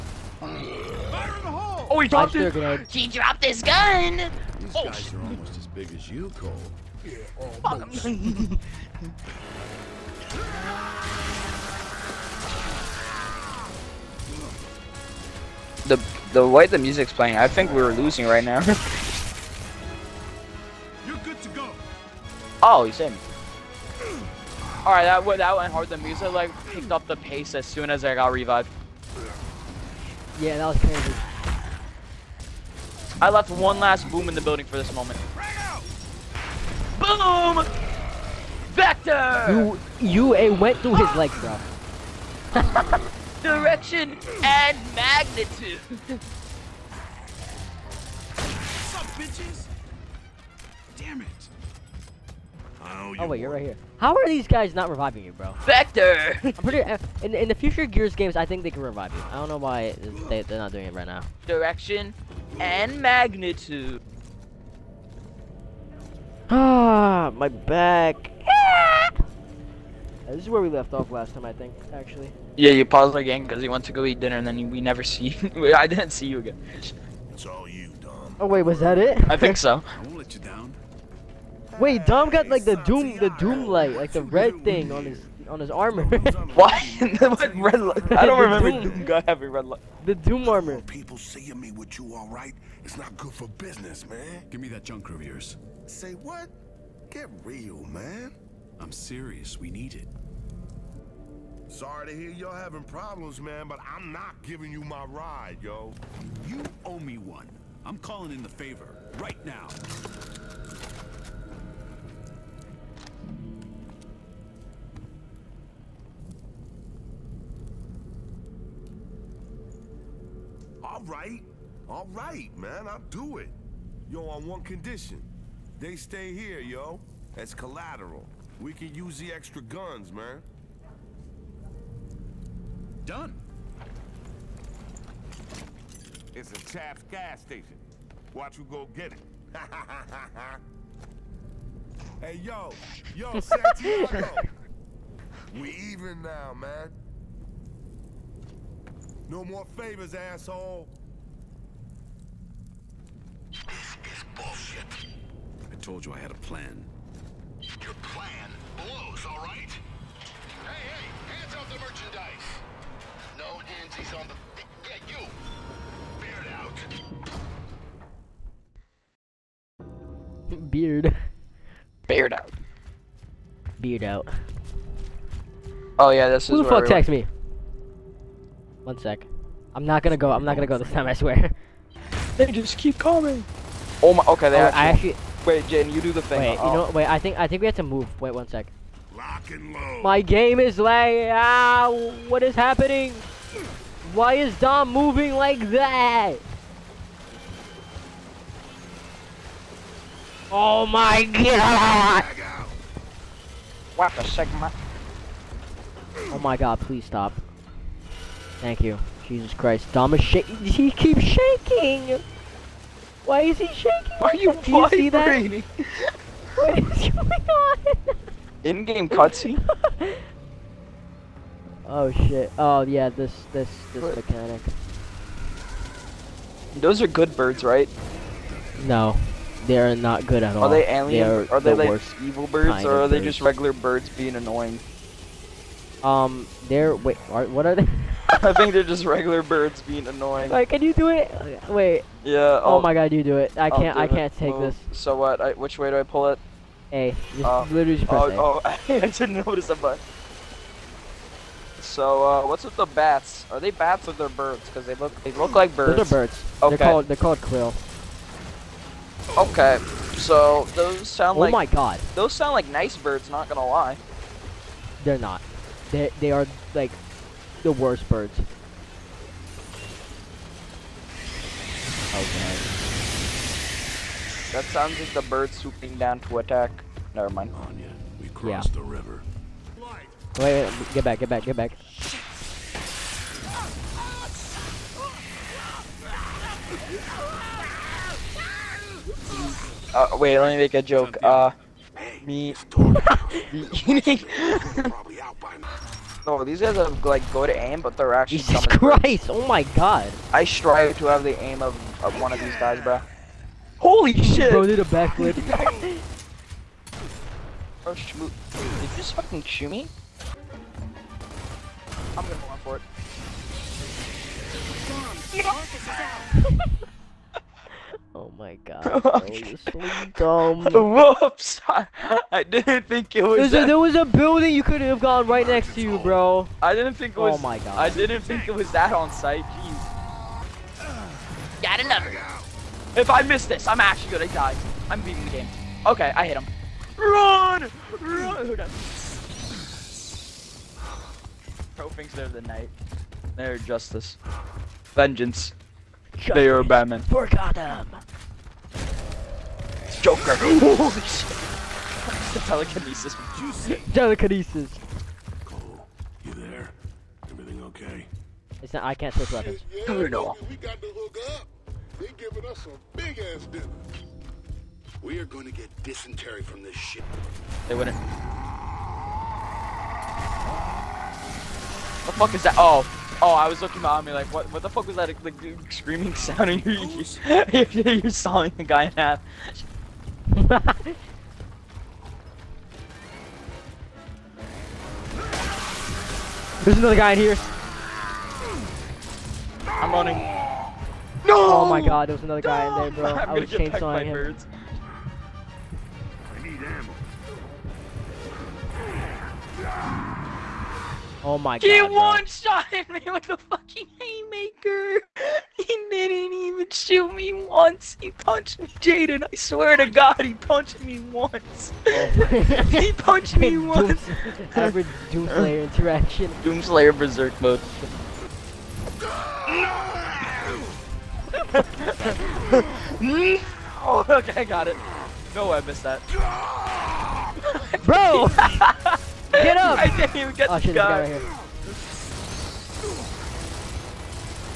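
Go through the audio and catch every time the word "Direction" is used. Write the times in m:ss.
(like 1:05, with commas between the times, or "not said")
0:43, 1:01.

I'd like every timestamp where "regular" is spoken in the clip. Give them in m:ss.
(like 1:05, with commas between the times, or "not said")
3:53, 3:59.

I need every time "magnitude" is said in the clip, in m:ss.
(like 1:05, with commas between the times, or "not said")
0:44, 1:02.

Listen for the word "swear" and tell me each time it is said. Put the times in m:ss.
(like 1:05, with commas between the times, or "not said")
3:01, 6:49.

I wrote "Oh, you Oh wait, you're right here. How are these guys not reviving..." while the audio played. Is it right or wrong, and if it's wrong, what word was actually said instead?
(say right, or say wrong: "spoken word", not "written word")
right.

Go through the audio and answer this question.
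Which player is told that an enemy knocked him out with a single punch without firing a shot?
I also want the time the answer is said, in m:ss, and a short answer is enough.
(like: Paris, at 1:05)
Jaden, at 6:48.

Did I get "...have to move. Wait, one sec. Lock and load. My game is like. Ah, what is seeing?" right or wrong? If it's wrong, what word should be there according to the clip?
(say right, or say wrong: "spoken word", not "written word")
wrong: "happening", not "seeing".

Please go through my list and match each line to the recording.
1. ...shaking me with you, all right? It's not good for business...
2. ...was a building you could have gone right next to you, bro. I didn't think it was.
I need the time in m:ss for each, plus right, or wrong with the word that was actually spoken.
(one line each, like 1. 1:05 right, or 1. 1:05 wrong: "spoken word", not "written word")
1. 1:31 wrong: "seeing", not "shaking"
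2. 5:23 right.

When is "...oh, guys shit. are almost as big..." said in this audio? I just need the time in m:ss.
0:04.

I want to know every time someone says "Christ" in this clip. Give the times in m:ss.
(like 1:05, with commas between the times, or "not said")
3:29, 4:58.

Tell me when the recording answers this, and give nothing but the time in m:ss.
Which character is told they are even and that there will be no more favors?
2:23.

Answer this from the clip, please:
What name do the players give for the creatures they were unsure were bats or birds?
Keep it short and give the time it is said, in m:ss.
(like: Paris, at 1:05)
Kryll, at 4:17.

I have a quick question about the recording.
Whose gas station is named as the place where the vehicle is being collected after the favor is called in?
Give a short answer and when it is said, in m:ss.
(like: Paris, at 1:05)
Chap, at 2:16.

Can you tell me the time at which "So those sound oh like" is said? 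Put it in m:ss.
4:20.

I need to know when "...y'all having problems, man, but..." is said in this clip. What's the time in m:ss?
1:42.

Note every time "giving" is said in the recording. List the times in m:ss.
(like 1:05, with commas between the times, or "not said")
1:44, 6:02.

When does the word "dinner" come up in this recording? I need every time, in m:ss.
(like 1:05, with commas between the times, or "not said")
1:14, 6:03.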